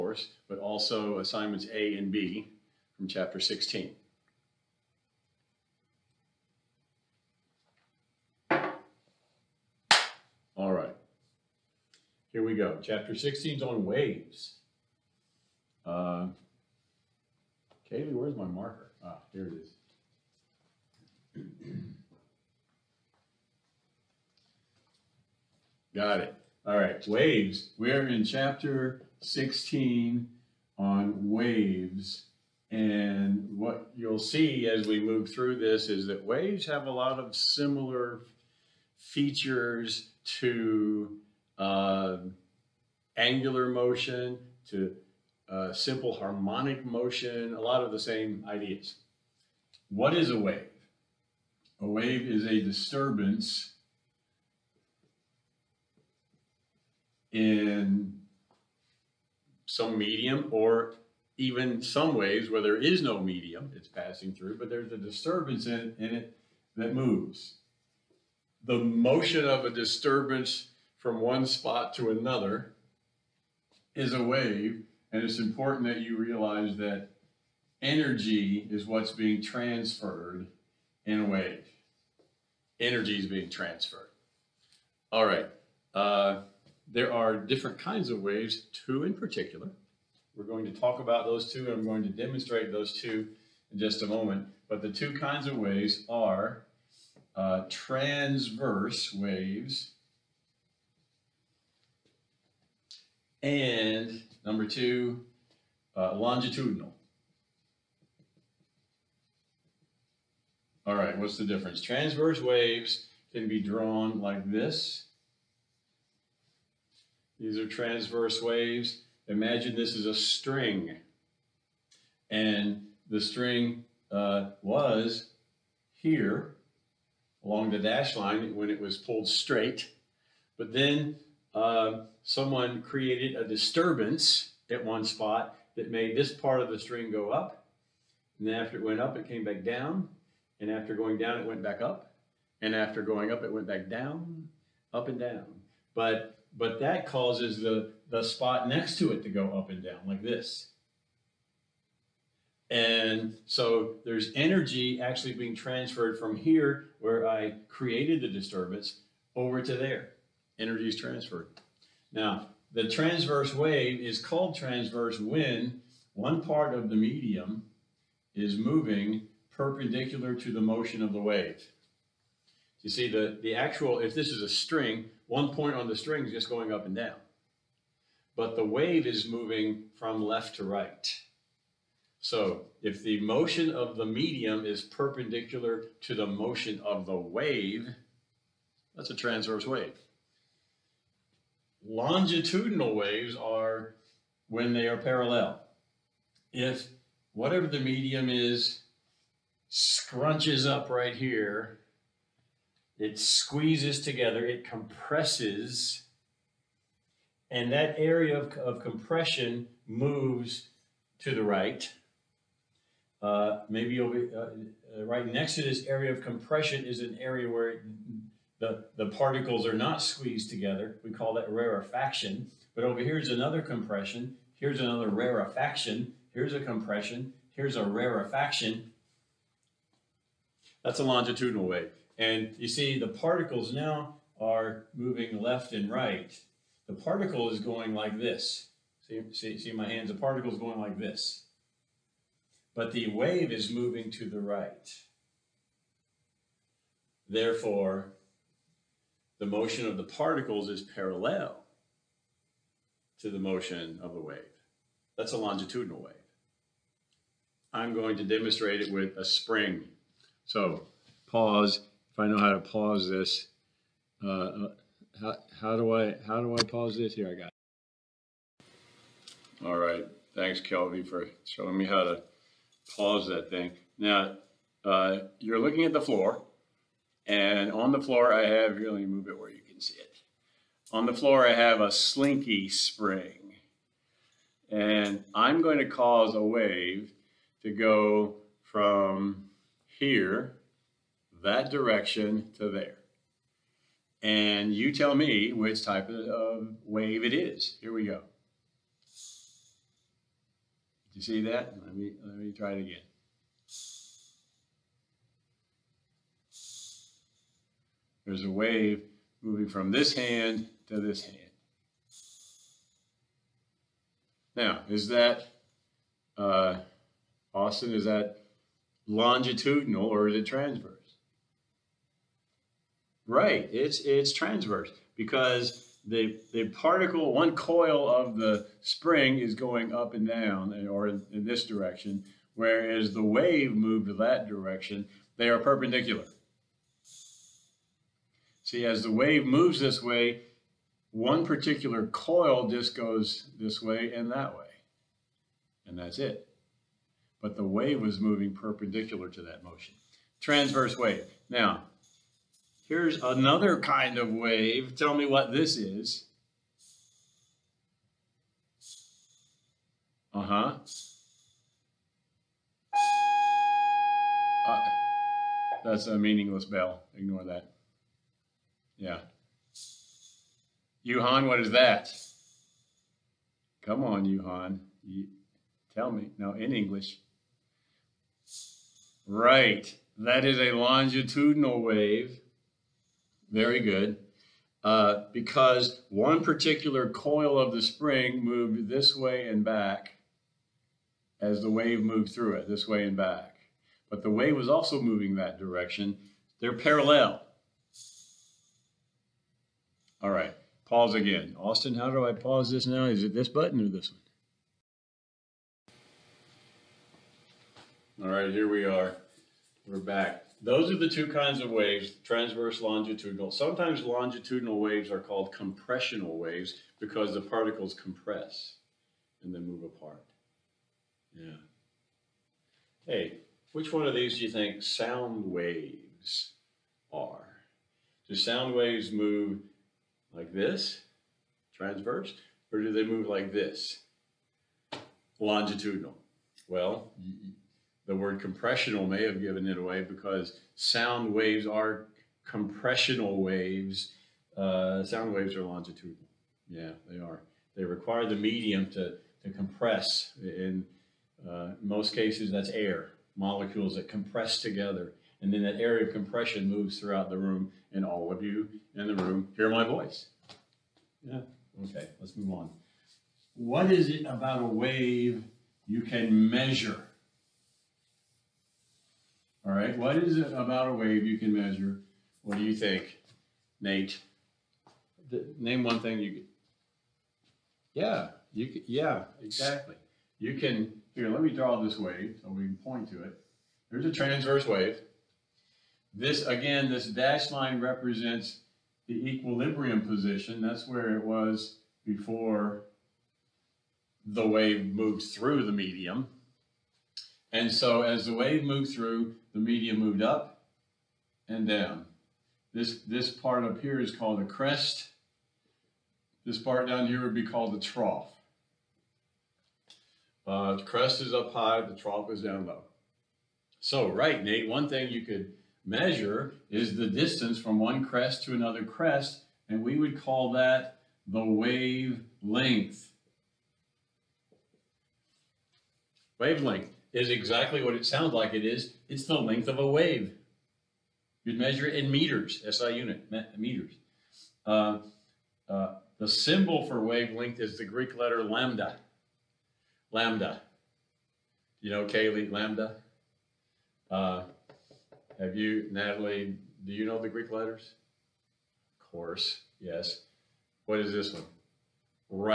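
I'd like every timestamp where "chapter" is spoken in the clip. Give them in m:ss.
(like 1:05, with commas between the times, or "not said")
0:03, 0:12, 0:28.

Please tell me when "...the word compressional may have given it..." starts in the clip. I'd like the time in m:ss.
7:18.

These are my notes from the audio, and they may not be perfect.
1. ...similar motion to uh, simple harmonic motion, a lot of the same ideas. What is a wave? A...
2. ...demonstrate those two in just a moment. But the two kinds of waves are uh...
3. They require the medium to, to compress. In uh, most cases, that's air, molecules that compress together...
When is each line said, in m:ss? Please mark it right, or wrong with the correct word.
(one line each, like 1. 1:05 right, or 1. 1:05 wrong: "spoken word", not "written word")
1. 0:43 wrong: "angular", not "similar"
2. 1:32 right
3. 7:27 right.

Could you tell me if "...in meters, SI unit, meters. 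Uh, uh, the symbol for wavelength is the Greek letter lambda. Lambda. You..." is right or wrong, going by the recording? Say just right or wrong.
right.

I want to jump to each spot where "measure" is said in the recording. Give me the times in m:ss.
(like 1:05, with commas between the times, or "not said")
7:46, 7:51, 8:35, 8:51.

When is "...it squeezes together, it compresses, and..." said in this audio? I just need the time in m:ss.
3:22.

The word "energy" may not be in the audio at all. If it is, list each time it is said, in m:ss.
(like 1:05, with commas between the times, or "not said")
1:17, 1:22, 2:34, 2:40.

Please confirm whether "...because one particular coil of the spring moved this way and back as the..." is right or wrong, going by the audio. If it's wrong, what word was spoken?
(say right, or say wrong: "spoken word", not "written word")
right.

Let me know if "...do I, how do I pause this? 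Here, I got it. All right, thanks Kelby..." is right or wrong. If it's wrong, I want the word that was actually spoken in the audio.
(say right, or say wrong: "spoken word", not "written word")
right.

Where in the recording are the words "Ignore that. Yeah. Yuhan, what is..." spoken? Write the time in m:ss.
6:07.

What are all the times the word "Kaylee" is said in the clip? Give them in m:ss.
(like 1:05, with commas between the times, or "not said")
0:17, 9:02.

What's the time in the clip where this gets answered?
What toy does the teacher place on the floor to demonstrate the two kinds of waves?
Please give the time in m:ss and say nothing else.
4:41.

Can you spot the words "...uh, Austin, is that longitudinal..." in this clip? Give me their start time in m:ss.
5:16.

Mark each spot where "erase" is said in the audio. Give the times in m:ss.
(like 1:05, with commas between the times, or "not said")
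not said.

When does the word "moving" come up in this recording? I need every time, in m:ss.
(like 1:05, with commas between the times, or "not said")
2:48, 2:59, 3:54, 4:03, 5:09, 5:48, 6:35.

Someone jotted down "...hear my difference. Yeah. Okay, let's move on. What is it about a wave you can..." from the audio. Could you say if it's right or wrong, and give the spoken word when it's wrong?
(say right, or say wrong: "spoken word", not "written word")
wrong: "voice", not "difference".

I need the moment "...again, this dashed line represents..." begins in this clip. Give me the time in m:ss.
8:06.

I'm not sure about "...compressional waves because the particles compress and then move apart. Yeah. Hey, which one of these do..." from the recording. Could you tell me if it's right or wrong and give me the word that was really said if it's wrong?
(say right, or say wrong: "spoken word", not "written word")
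right.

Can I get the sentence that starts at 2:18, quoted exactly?
And then after it went up, it came back down.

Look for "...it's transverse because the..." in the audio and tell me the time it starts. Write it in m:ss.
5:24.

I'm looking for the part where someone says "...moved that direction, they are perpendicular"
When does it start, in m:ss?
5:33.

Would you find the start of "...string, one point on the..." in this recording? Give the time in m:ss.
2:54.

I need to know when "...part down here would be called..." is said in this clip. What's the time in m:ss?
8:26.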